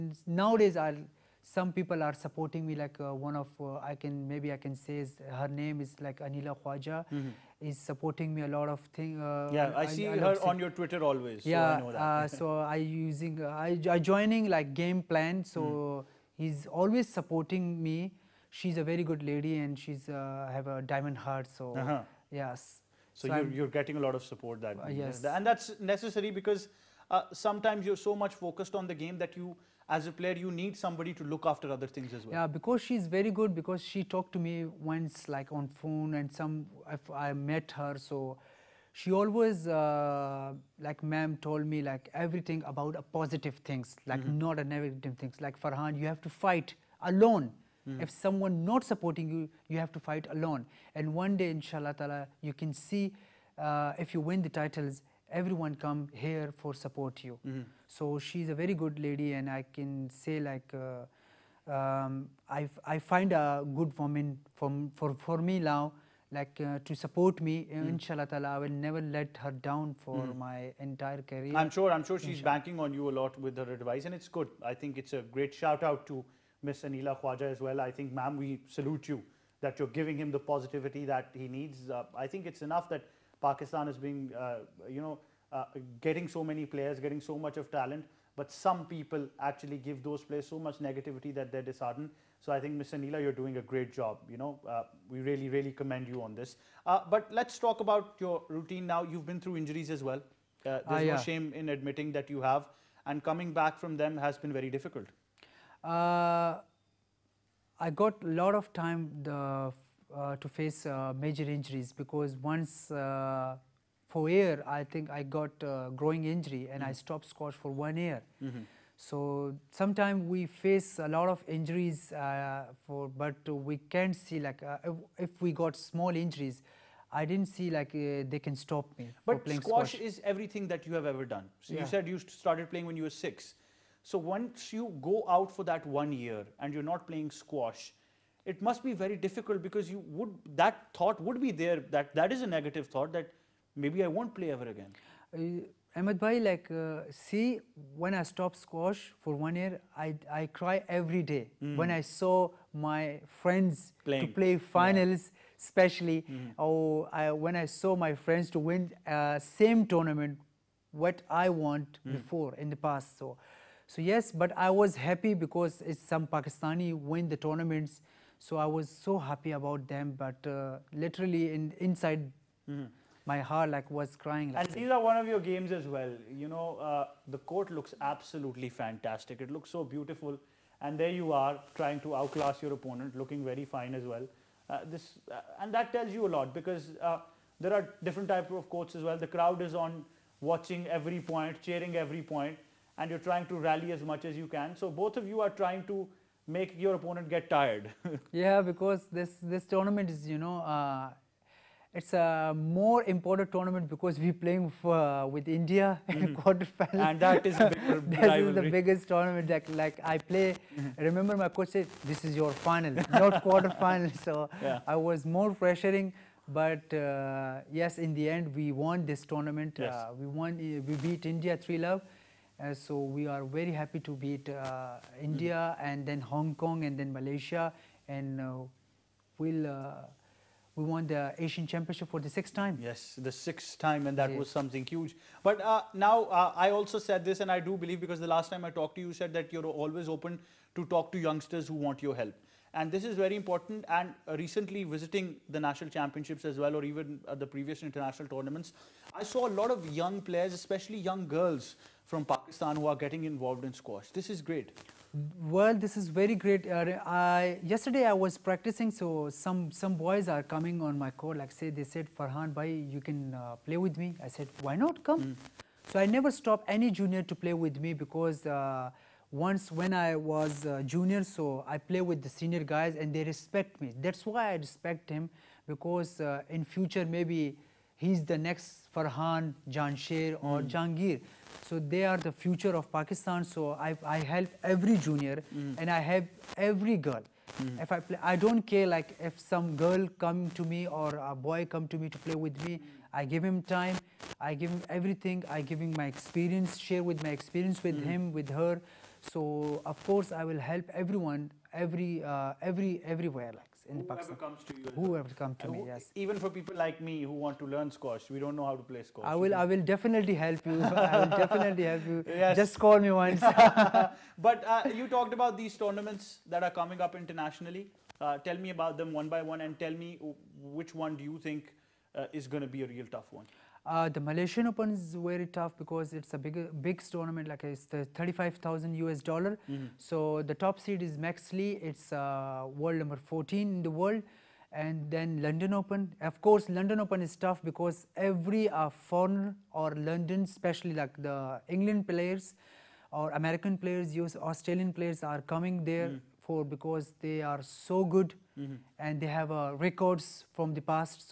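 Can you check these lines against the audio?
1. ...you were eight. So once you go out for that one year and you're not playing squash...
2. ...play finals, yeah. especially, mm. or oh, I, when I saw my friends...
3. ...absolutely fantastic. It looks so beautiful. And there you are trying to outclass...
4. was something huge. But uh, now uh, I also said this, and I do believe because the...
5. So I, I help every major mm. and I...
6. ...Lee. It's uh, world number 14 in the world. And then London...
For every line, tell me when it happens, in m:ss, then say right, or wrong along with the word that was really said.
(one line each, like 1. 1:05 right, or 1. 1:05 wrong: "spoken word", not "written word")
1. 2:12 wrong: "six", not "eight"
2. 2:34 right
3. 2:57 right
4. 3:54 right
5. 4:43 wrong: "junior", not "major"
6. 5:31 right.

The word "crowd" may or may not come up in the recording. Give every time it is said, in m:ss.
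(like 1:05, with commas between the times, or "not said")
3:09.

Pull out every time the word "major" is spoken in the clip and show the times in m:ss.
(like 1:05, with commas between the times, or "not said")
1:51.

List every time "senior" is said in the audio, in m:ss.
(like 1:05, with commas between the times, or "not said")
4:32.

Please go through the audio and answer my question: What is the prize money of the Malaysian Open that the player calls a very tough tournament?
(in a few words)
$35,000.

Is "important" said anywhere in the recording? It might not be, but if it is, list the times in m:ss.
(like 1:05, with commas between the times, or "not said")
3:23, 4:03.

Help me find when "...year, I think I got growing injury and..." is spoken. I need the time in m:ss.
1:54.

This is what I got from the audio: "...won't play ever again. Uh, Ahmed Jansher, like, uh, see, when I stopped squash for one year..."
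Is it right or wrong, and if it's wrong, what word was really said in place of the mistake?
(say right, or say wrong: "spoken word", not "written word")
wrong: "Bhai", not "Jansher".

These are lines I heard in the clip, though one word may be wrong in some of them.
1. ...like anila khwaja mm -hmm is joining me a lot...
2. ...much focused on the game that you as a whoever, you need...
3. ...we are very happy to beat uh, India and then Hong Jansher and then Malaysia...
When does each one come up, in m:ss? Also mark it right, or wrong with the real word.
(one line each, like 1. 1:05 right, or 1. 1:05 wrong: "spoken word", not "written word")
1. 0:06 wrong: "supporting", not "joining"
2. 0:28 wrong: "player", not "whoever"
3. 3:43 wrong: "Kong", not "Jansher".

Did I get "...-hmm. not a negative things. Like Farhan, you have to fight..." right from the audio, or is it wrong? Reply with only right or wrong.
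right.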